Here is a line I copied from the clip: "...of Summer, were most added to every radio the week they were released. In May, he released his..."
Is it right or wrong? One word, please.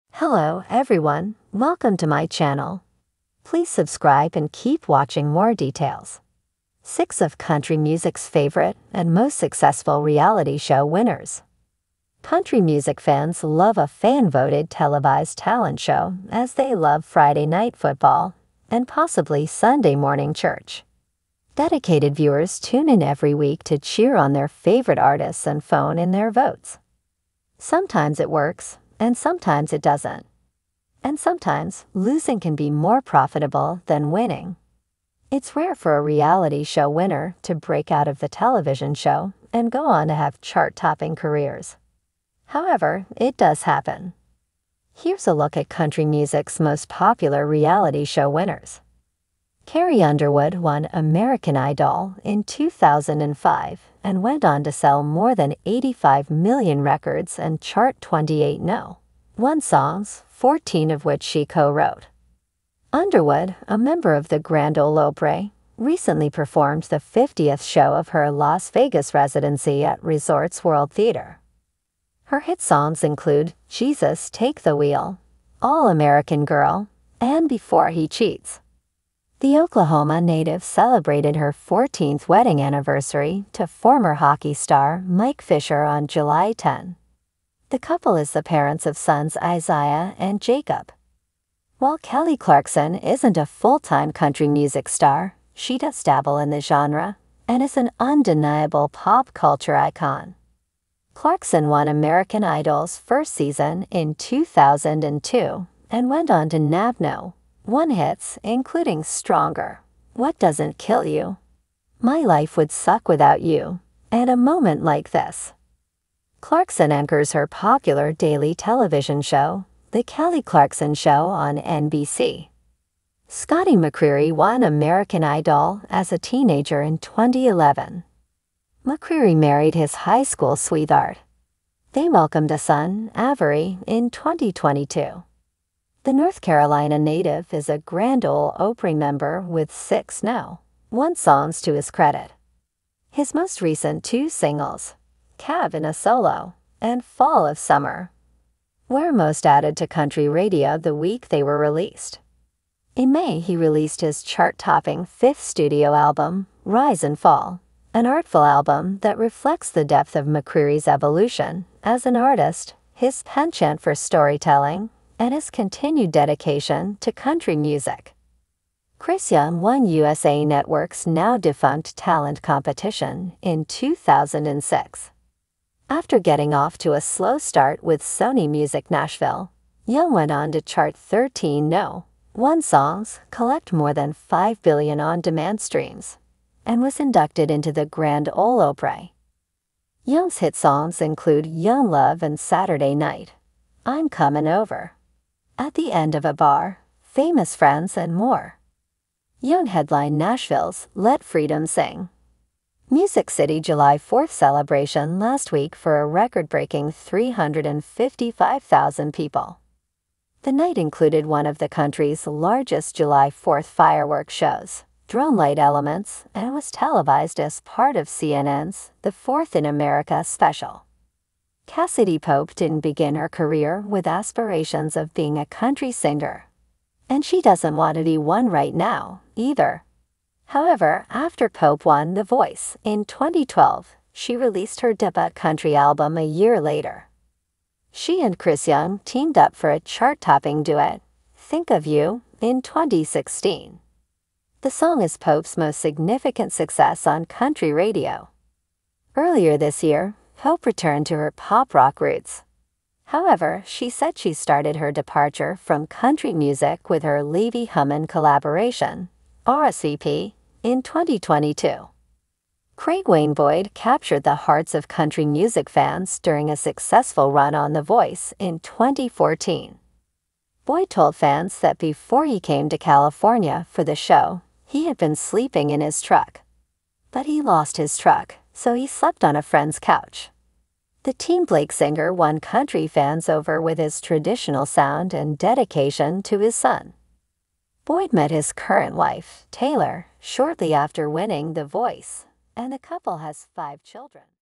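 wrong.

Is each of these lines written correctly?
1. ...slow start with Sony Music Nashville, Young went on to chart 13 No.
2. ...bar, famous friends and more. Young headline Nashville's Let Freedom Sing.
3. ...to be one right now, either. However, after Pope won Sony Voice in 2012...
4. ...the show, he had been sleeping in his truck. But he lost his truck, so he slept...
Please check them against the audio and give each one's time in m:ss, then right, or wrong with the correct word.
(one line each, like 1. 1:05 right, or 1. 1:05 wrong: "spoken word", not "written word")
1. 2:57 right
2. 3:16 right
3. 3:47 wrong: "The", not "Sony"
4. 4:33 right.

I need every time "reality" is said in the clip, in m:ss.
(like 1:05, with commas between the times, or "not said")
0:10, 0:36, 0:47.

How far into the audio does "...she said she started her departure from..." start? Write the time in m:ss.
4:13.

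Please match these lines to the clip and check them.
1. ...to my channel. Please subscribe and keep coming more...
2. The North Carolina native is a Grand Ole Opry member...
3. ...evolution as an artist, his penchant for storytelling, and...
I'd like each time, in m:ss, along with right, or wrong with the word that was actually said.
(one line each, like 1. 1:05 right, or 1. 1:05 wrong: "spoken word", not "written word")
1. 0:01 wrong: "watching", not "coming"
2. 2:16 right
3. 2:40 right.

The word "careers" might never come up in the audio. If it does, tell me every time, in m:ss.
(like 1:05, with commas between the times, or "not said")
0:41, 3:43.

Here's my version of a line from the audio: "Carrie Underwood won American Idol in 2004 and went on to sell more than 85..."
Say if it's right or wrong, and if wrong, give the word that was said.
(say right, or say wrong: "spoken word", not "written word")
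wrong: "2005", not "2004".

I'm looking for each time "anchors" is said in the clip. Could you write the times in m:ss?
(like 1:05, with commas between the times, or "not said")
1:56.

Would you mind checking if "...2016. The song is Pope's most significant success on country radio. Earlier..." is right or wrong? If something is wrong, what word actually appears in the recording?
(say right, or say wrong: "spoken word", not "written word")
right.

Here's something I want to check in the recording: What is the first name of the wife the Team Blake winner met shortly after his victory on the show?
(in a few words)
Taylor.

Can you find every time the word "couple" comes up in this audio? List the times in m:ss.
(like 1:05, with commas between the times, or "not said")
1:27, 4:52.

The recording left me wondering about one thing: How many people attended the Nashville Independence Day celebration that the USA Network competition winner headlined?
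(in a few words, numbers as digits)
355,000.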